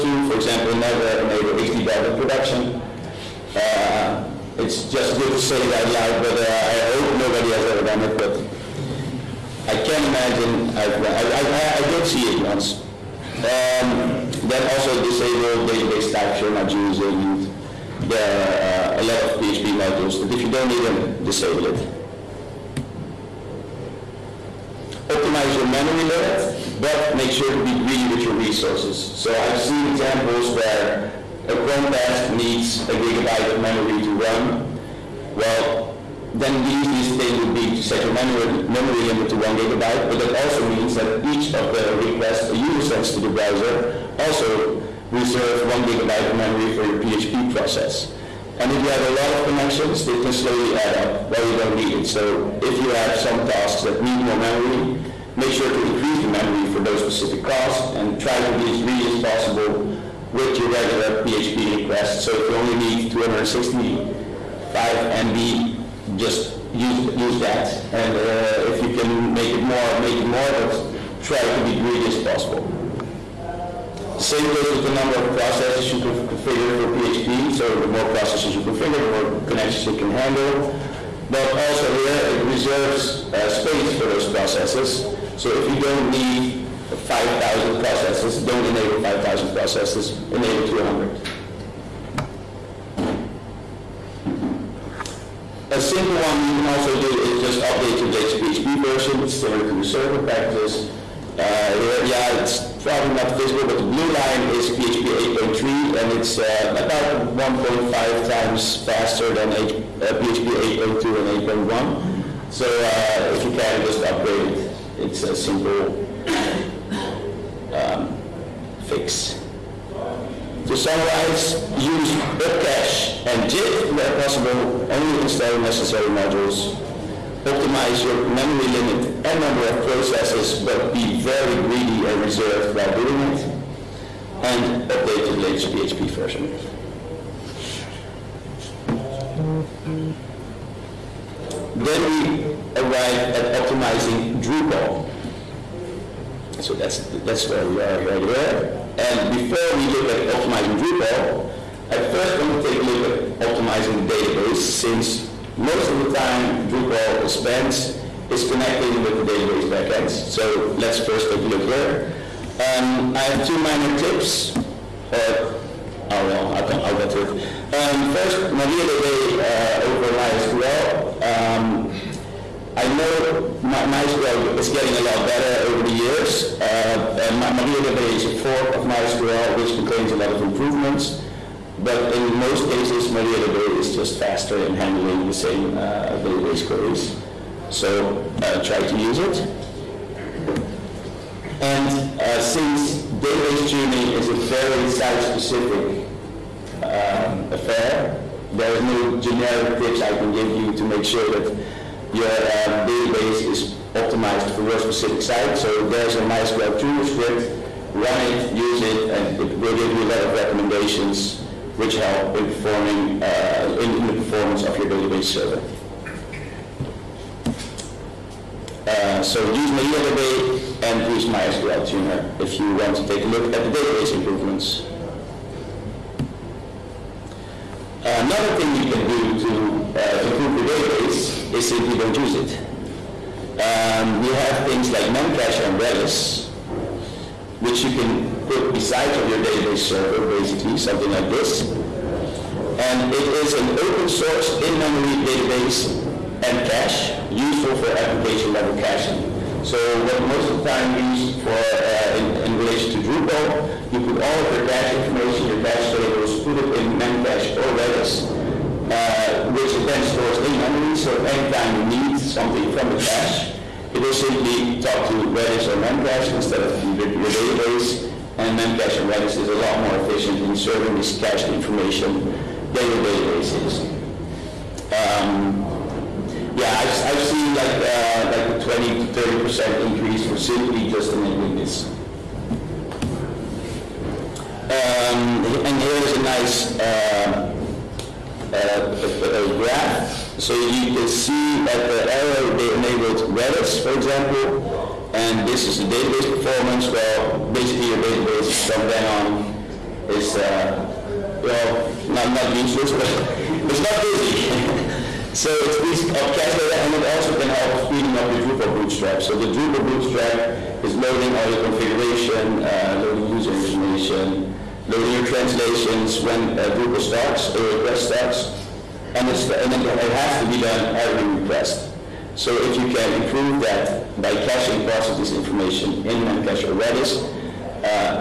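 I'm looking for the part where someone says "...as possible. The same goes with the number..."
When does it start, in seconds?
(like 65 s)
72 s.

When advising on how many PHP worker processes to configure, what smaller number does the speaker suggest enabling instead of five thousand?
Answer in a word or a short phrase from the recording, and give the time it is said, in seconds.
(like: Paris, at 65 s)
200, at 90 s.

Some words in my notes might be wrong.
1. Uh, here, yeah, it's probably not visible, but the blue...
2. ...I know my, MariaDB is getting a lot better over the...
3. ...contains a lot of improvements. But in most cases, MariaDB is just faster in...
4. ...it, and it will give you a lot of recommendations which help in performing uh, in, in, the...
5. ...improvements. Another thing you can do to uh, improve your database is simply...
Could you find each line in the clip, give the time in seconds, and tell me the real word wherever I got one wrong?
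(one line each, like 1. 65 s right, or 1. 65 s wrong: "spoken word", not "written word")
1. 101 s right
2. 172 s wrong: "MySQL", not "MariaDB"
3. 179 s right
4. 208 s right
5. 224 s right.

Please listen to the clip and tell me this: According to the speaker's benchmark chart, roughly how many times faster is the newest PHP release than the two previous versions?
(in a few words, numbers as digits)
1.5 times.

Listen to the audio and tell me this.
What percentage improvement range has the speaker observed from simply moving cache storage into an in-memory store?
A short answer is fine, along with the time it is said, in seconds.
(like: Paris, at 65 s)
20 to 30 percent, at 278 s.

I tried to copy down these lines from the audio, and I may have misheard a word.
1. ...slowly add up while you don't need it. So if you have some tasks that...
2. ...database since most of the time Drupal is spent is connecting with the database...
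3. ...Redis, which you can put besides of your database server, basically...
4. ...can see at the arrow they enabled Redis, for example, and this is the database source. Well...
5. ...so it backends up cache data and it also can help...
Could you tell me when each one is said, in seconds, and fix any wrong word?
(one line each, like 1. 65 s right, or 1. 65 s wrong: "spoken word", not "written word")
1. 50 s right
2. 154 s right
3. 235 s right
4. 290 s wrong: "performance", not "source"
5. 305 s wrong: "speeds", not "backends".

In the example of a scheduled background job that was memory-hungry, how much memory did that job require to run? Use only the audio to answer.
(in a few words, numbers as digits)
1 gigabyte.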